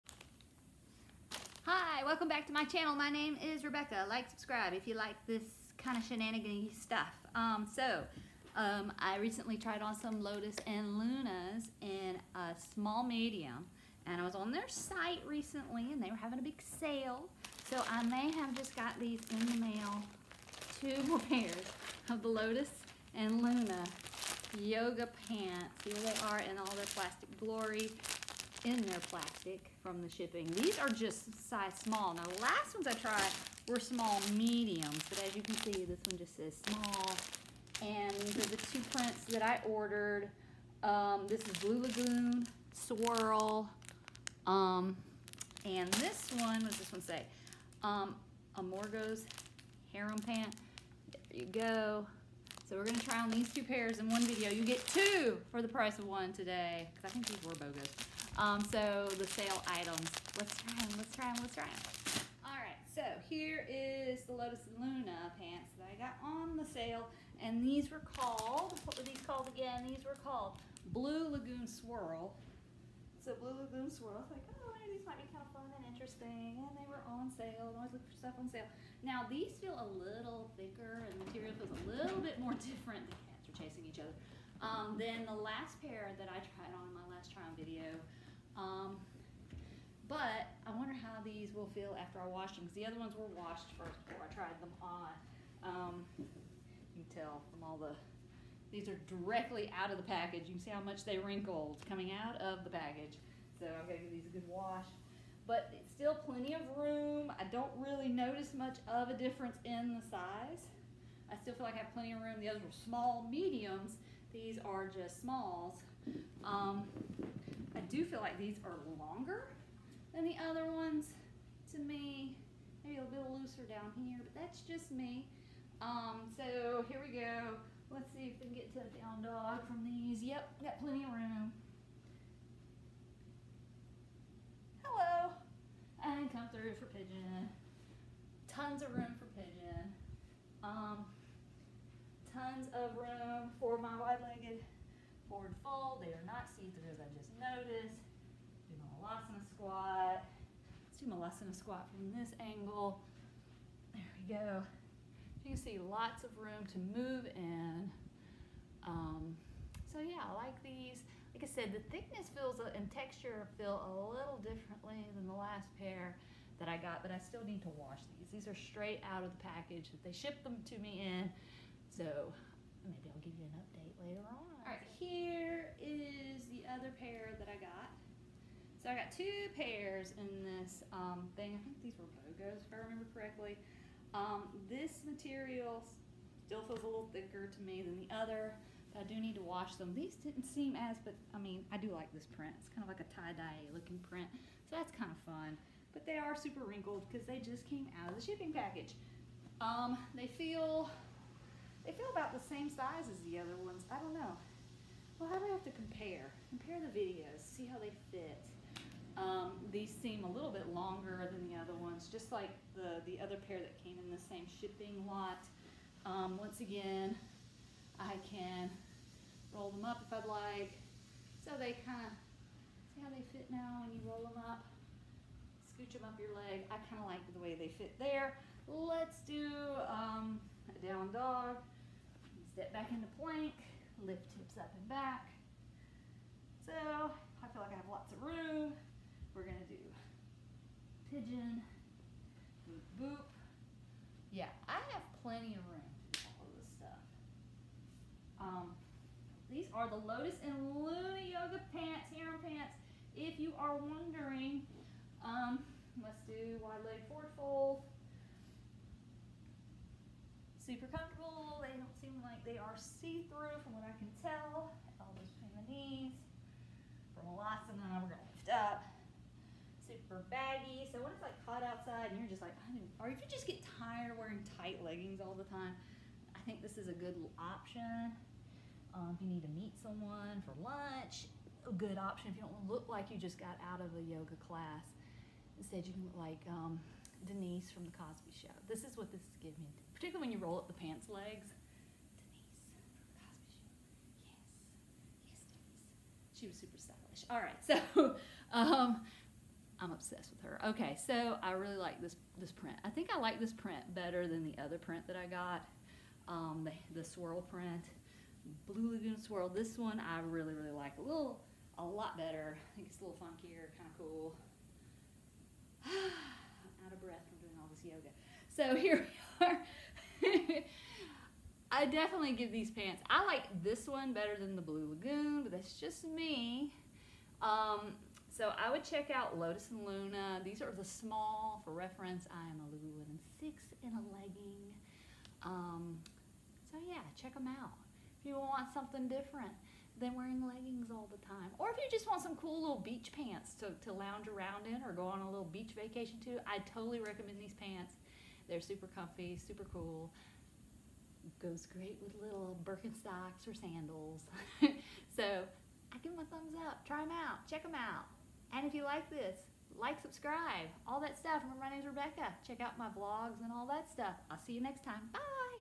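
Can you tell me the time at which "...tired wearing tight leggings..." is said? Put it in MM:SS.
04:33.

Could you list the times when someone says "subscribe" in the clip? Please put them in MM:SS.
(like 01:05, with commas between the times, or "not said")
00:04, 06:00.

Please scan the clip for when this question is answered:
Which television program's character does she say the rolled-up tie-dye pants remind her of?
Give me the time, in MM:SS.
04:47.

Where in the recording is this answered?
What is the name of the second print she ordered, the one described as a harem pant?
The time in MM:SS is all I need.
00:48.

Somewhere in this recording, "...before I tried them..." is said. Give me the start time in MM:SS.
01:34.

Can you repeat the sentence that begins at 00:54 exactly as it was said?
You get two for the price of one today, because I think these were BOGOs.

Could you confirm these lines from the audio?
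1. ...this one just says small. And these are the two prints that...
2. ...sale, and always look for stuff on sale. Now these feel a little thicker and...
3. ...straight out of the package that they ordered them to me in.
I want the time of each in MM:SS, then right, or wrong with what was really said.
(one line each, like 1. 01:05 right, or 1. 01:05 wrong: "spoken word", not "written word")
1. 00:35 right
2. 01:17 right
3. 02:48 wrong: "shipped", not "ordered".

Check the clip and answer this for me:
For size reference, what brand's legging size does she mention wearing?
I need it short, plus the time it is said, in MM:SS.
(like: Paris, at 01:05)
Lululemon, at 05:32.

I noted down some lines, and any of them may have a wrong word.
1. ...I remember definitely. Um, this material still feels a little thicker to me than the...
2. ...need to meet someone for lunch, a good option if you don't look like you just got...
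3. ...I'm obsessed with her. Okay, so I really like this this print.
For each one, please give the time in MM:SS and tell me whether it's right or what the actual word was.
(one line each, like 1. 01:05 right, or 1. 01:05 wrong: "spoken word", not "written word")
1. 03:02 wrong: "correctly", not "definitely"
2. 04:39 right
3. 04:59 right.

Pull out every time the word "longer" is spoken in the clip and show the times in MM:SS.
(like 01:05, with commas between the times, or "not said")
01:58, 03:30.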